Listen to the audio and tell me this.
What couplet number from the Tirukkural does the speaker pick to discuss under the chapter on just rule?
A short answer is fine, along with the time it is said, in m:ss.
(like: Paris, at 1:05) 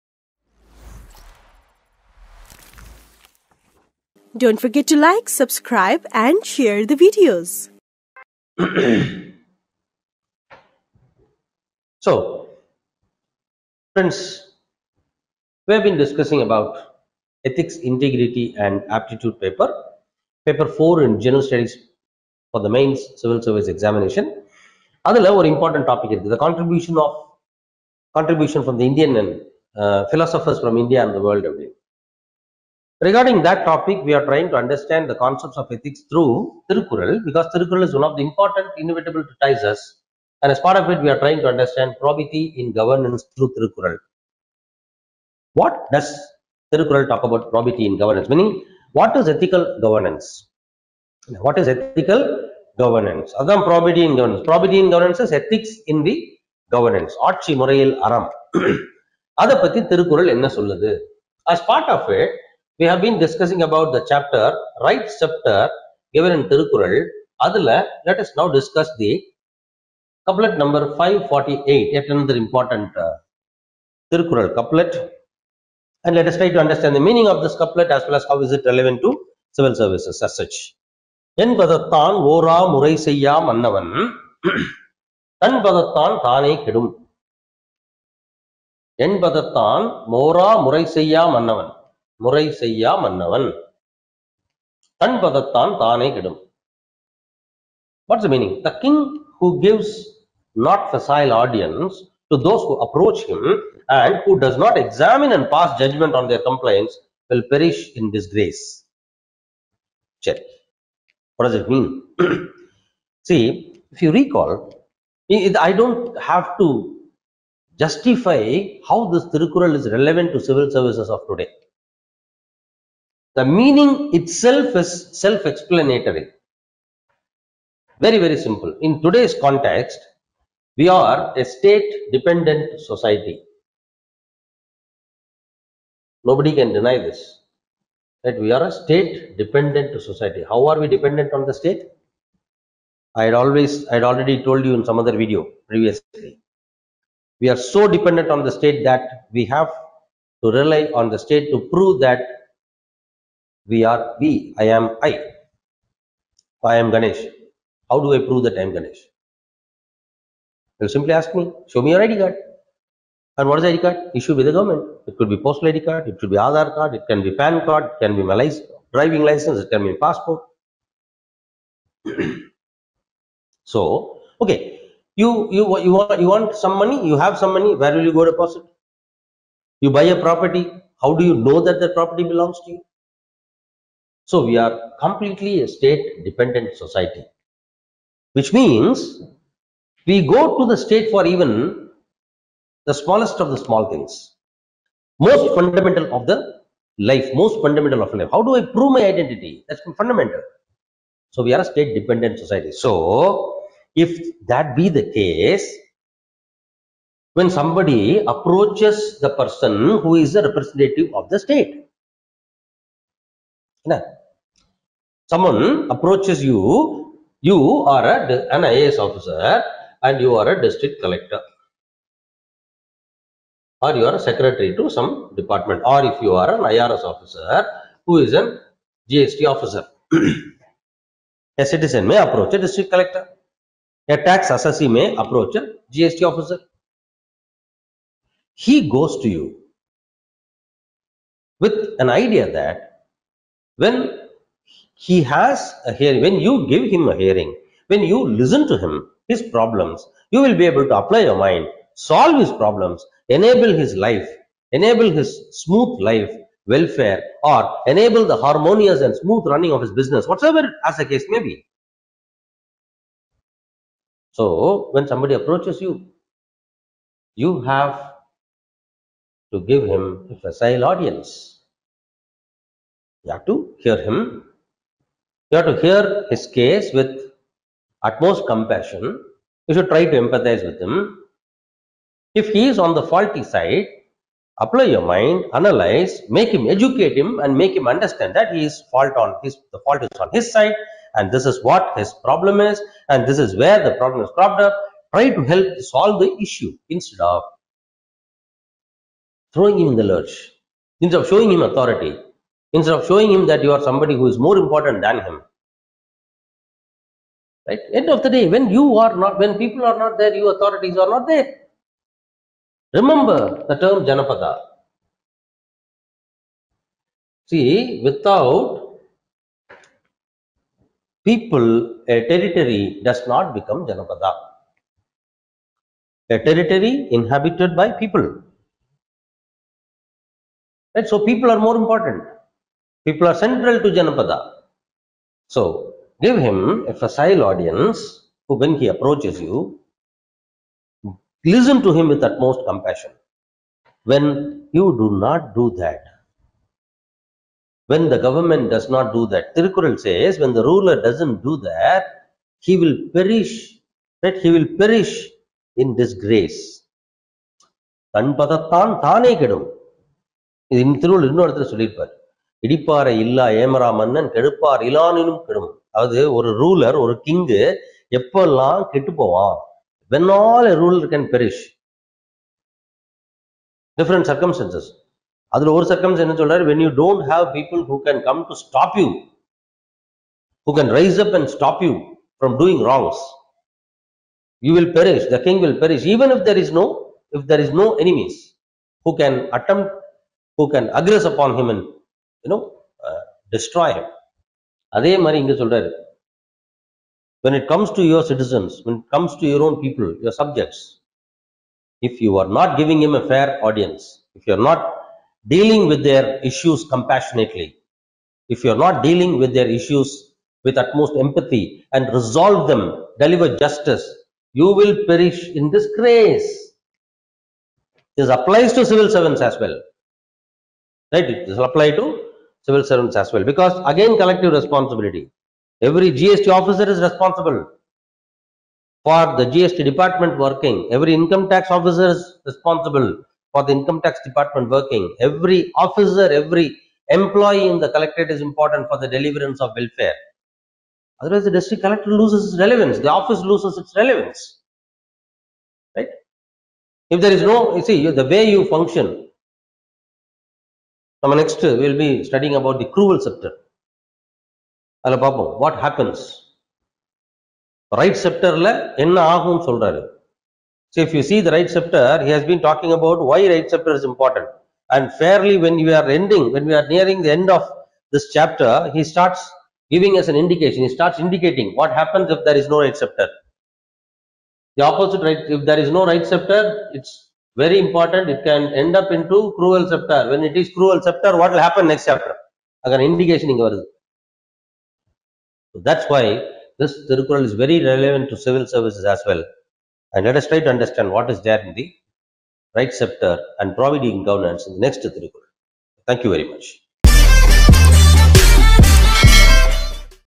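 548, at 1:10.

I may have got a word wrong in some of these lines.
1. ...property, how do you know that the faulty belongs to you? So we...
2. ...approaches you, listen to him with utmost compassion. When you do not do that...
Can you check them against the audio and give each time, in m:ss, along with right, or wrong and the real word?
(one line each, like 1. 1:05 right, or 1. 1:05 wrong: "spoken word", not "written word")
1. 3:00 wrong: "property", not "faulty"
2. 5:38 right.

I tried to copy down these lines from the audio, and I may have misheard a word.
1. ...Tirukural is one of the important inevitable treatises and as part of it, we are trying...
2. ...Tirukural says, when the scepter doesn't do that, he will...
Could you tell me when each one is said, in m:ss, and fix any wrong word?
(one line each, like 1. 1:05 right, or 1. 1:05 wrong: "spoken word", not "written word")
1. 0:37 right
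2. 5:49 wrong: "ruler", not "scepter".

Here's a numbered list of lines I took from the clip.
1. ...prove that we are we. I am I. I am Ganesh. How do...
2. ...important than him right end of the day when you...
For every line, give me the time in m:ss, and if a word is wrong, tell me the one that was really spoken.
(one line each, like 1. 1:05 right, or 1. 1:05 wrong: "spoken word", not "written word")
1. 2:31 right
2. 5:04 right.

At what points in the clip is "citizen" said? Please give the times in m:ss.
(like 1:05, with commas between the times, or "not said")
3:51, 6:38.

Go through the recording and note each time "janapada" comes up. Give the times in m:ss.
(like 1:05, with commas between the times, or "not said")
5:14, 5:23, 5:33.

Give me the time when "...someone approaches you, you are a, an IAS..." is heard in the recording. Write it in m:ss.
3:35.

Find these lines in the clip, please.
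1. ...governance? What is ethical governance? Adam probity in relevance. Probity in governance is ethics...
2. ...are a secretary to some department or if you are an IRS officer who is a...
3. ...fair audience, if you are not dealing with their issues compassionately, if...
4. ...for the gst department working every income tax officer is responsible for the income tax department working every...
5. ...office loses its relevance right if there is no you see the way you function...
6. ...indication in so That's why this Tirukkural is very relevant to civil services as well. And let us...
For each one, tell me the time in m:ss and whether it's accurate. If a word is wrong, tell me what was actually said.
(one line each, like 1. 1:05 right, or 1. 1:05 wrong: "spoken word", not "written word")
1. 0:49 wrong: "governance", not "relevance"
2. 3:44 right
3. 6:43 right
4. 7:09 right
5. 7:23 right
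6. 8:03 right.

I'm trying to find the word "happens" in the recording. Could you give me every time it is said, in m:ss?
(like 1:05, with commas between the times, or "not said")
7:52, 8:01.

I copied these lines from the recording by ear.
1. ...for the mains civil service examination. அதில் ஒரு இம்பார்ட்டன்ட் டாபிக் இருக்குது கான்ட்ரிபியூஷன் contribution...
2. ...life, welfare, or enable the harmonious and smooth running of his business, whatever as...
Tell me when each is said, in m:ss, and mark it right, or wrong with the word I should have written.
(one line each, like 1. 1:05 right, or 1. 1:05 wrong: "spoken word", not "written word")
1. 0:22 right
2. 4:16 right.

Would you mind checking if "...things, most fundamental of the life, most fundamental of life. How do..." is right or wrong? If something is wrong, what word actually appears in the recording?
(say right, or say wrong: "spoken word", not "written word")
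right.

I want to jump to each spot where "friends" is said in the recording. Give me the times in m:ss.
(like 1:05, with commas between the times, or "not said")
0:13.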